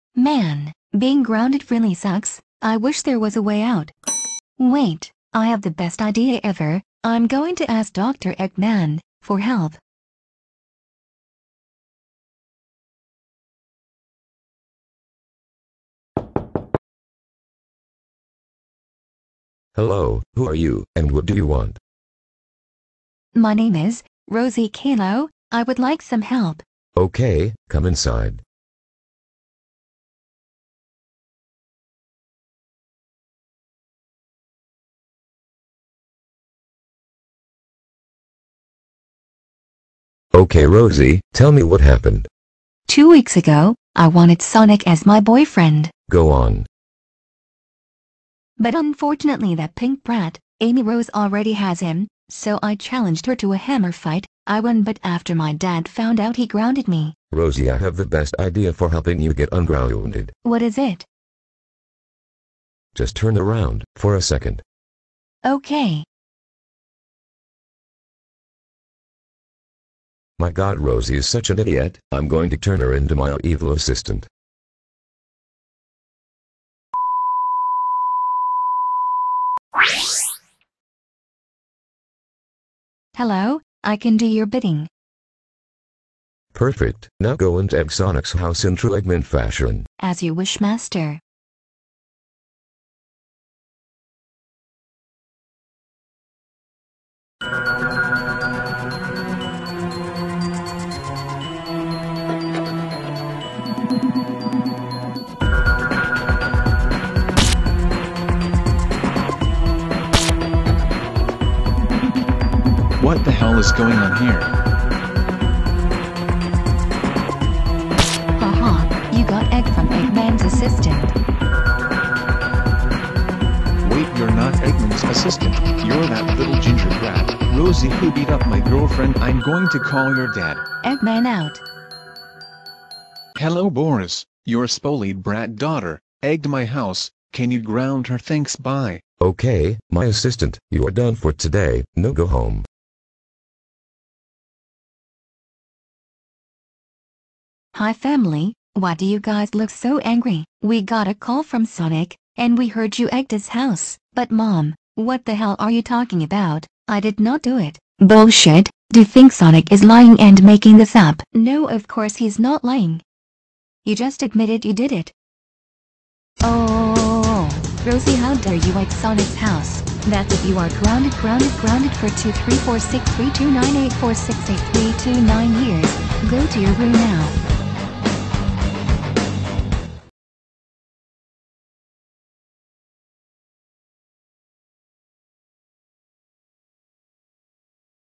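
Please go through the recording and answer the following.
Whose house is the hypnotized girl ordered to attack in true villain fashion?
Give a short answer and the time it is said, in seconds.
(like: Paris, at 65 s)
Exonic's house, at 87 s.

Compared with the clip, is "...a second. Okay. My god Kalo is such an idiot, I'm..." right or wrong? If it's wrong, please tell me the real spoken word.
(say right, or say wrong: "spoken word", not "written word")
wrong: "Rosie", not "Kalo".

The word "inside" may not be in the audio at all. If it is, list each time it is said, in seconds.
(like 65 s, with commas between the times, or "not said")
27 s.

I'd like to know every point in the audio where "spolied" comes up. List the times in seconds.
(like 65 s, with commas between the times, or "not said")
134 s.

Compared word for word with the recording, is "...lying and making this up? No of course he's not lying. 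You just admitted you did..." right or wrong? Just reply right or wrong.
right.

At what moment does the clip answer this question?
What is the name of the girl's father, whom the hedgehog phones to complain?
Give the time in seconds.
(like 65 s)
133 s.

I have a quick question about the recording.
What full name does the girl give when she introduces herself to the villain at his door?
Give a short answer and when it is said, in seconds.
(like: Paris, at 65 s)
Rosie Kalo, at 24 s.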